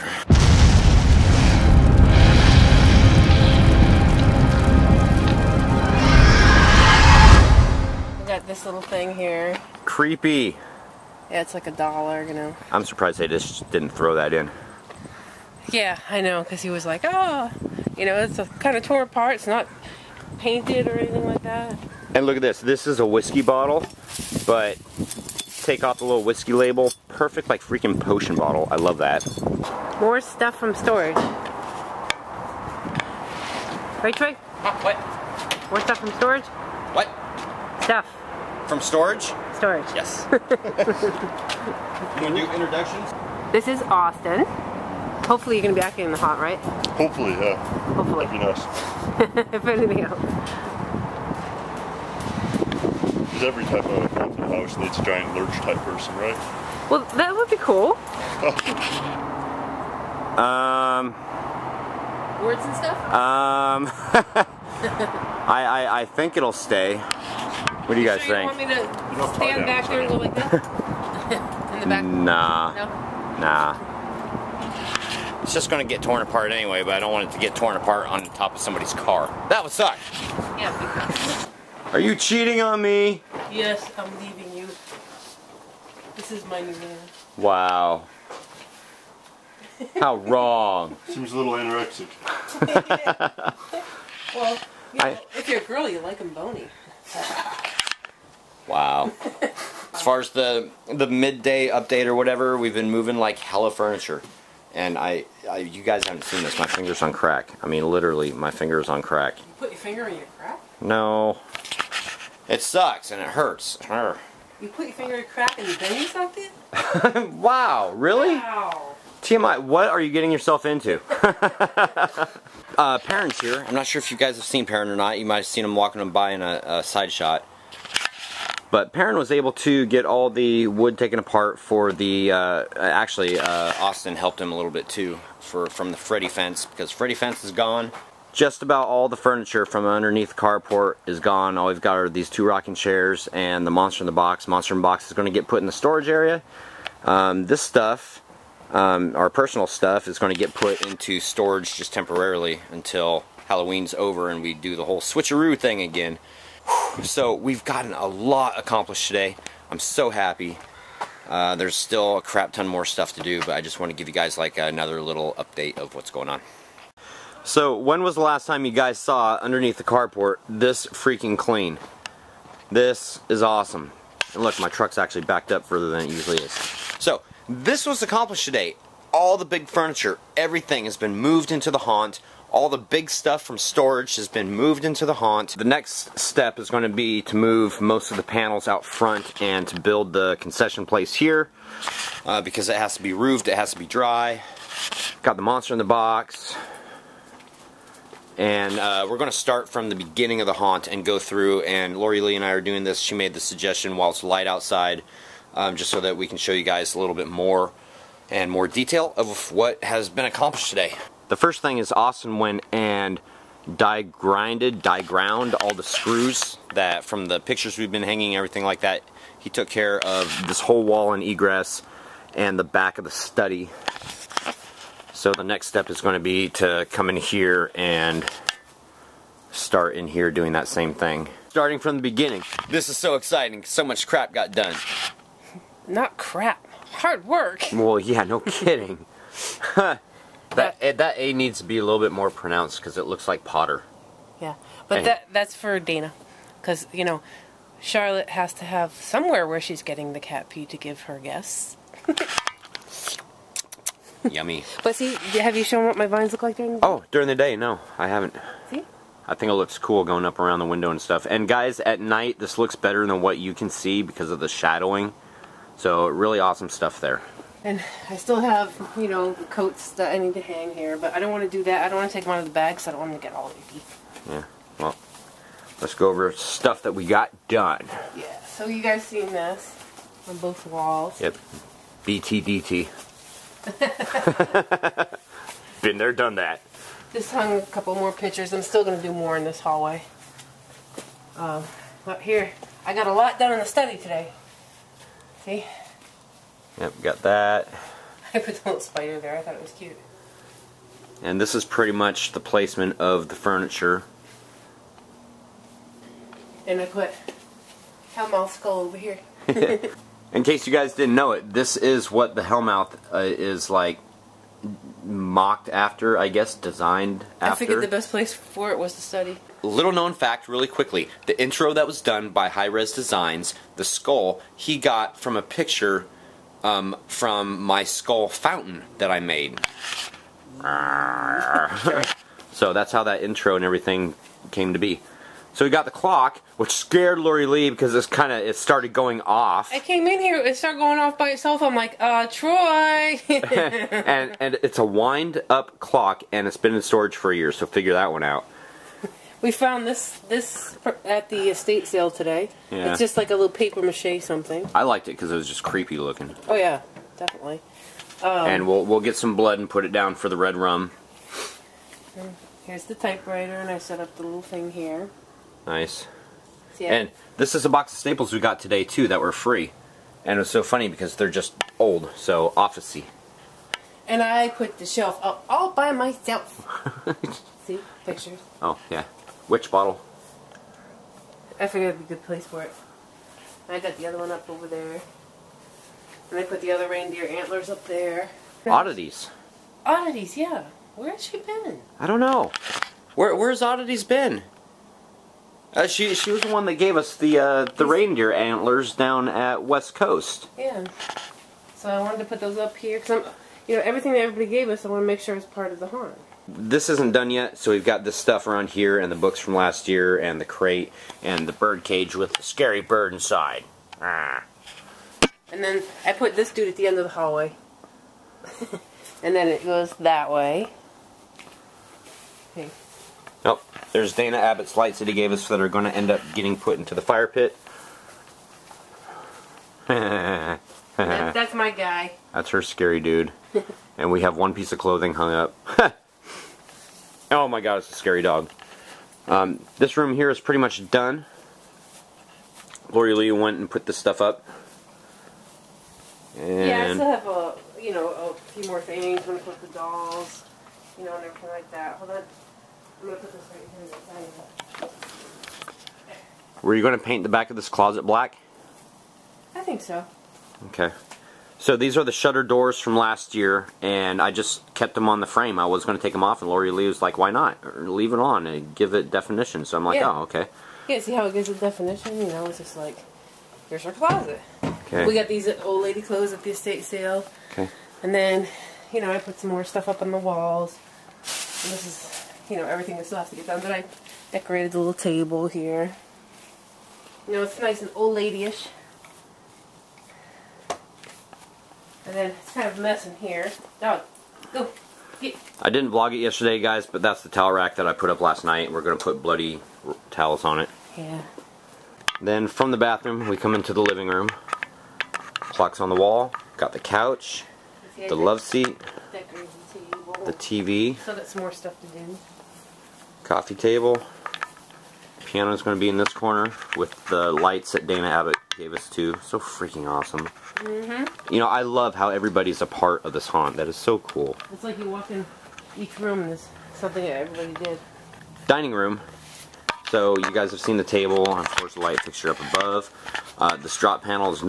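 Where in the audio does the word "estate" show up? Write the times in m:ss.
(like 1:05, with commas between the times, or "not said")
5:51, 7:56.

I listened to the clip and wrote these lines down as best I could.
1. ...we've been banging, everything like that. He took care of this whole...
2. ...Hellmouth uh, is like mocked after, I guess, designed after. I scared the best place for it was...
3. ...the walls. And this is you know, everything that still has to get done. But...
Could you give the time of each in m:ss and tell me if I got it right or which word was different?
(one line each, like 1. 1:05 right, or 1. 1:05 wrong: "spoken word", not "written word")
1. 3:37 wrong: "hanging", not "banging"
2. 5:12 wrong: "figured", not "scared"
3. 8:00 right.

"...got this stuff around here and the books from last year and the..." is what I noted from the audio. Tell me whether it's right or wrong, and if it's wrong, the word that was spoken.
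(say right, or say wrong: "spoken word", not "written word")
right.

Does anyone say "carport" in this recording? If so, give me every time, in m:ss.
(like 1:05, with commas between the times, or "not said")
2:20, 2:49.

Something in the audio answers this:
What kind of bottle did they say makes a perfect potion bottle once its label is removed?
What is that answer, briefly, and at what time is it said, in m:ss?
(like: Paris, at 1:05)
whiskey bottle, at 0:23.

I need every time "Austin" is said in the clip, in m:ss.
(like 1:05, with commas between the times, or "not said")
0:43, 2:13, 3:31.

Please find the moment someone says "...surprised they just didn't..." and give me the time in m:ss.
0:12.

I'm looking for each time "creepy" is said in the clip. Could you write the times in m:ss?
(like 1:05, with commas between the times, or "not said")
0:09, 5:55.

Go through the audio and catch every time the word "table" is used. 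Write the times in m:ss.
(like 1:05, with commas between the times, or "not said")
8:04, 8:33, 8:50.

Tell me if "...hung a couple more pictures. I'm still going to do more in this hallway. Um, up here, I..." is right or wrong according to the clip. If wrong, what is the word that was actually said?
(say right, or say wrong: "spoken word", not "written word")
right.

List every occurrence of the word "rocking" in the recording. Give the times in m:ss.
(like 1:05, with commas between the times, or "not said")
2:22.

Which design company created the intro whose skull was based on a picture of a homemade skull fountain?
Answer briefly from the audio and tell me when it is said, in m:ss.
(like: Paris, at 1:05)
Hi-Rez Designs, at 5:22.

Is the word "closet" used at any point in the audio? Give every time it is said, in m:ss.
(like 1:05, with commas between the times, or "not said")
7:37, 7:53.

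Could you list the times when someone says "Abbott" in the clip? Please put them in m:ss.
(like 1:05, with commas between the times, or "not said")
7:04, 8:38.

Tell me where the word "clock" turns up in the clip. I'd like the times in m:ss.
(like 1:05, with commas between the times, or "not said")
5:35, 5:45, 8:25.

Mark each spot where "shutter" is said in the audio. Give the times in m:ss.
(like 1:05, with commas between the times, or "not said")
7:42.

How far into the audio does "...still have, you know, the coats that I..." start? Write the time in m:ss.
4:28.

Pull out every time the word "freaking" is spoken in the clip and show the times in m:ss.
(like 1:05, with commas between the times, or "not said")
0:27, 2:50, 8:39.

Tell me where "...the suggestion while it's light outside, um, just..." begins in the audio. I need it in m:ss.
3:23.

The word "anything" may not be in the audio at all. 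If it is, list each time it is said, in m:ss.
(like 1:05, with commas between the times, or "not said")
0:20, 0:49.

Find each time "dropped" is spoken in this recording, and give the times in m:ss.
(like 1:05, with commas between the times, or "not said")
not said.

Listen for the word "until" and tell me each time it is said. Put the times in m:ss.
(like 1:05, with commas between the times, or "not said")
2:32.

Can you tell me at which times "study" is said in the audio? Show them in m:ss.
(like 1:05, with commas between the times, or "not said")
3:43, 4:53, 5:19.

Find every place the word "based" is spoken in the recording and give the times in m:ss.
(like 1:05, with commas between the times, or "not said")
not said.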